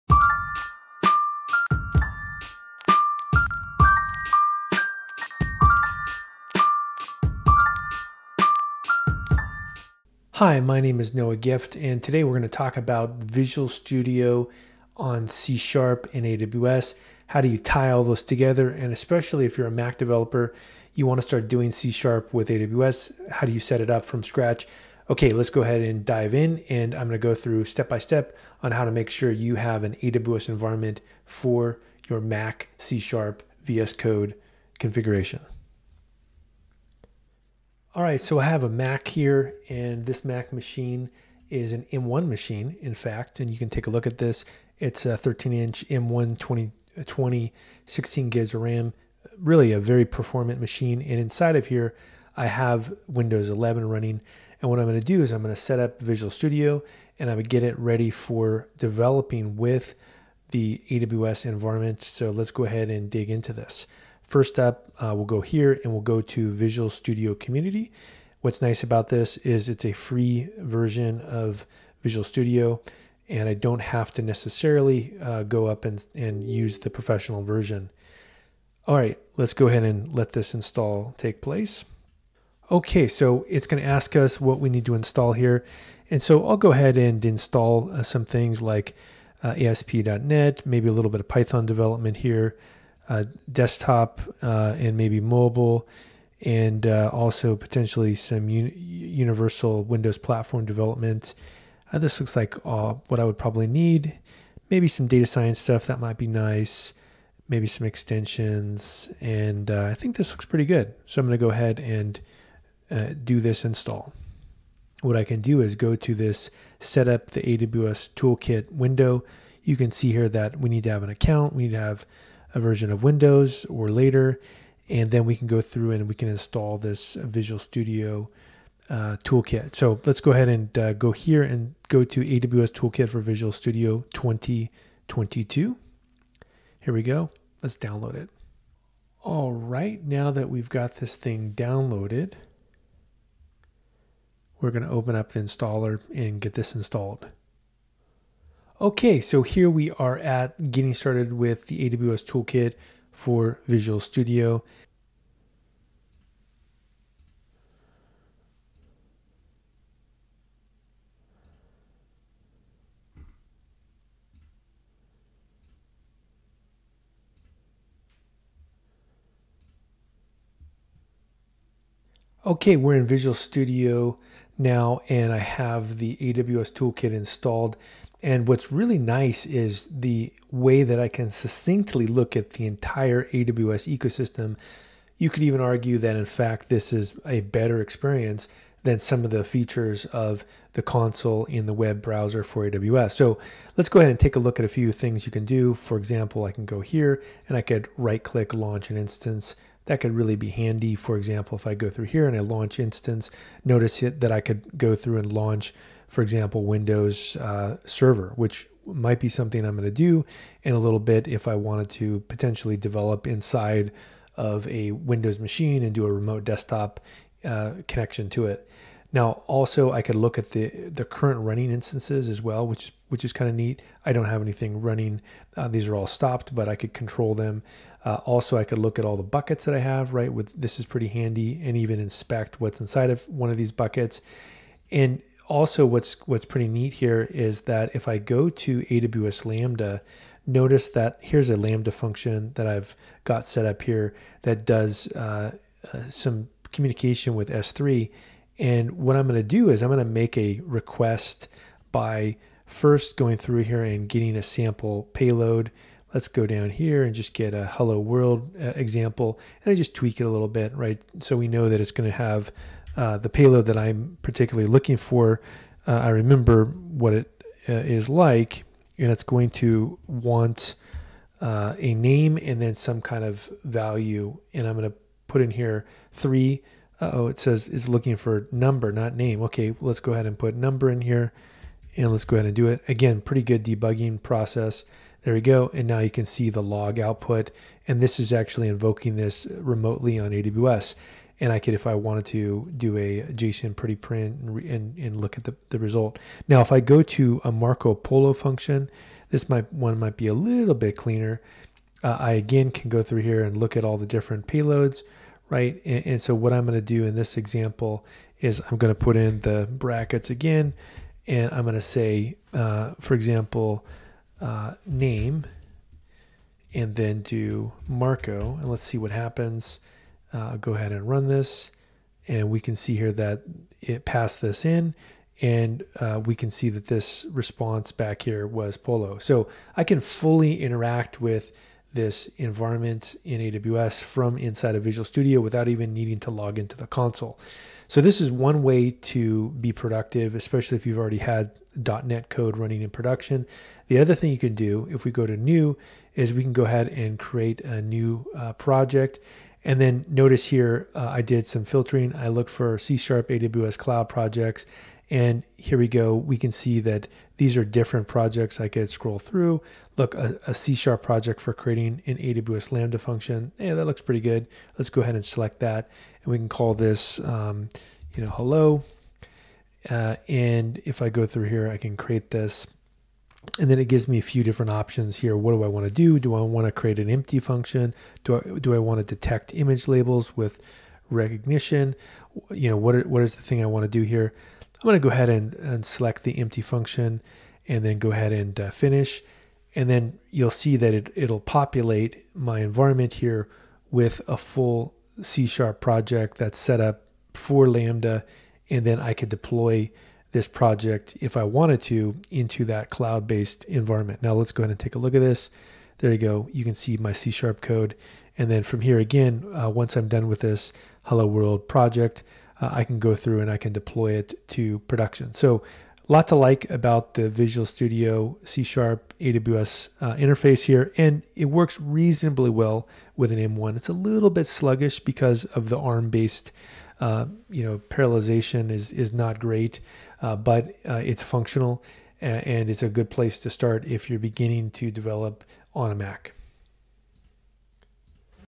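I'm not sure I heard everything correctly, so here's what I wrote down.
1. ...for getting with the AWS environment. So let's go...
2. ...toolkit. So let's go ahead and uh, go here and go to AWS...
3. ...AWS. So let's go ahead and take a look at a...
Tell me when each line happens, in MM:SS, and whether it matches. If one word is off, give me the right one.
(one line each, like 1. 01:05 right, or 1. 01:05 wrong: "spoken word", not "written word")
1. 00:58 wrong: "developing", not "getting"
2. 02:09 right
3. 03:12 right.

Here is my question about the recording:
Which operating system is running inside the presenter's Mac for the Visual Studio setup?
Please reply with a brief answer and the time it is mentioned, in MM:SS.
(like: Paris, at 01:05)
Windows 11, at 00:53.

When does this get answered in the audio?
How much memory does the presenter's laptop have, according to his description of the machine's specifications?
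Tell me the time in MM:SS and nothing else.
00:47.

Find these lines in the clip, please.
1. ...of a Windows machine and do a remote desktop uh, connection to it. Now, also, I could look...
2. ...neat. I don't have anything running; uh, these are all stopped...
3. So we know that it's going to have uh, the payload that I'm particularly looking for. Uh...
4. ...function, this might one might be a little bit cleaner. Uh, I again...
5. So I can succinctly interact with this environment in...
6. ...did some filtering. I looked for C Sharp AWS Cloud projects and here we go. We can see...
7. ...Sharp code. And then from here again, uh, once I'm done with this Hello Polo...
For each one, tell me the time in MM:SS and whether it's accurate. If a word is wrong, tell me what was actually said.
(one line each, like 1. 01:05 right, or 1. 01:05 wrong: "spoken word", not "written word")
1. 03:34 right
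2. 03:43 right
3. 04:21 right
4. 04:58 right
5. 05:29 wrong: "fully", not "succinctly"
6. 05:51 right
7. 06:47 wrong: "World", not "Polo".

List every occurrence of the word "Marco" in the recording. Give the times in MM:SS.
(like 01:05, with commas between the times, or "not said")
04:57, 05:17.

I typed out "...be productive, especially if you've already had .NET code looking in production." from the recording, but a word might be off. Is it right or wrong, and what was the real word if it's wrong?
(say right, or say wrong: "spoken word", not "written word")
wrong: "running", not "looking".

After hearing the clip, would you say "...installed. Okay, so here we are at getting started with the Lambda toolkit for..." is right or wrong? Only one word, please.
wrong.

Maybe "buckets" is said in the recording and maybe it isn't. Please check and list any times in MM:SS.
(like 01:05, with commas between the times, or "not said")
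03:49, 03:53.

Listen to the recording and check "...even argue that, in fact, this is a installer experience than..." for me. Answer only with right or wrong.
wrong.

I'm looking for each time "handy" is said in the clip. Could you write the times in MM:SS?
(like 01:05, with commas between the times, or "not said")
03:20, 03:51.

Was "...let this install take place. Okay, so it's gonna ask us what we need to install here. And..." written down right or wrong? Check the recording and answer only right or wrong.
right.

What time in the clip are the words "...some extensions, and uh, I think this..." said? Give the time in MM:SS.
01:47.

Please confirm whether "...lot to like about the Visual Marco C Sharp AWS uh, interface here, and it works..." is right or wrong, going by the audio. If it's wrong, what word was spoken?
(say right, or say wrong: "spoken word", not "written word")
wrong: "Studio", not "Marco".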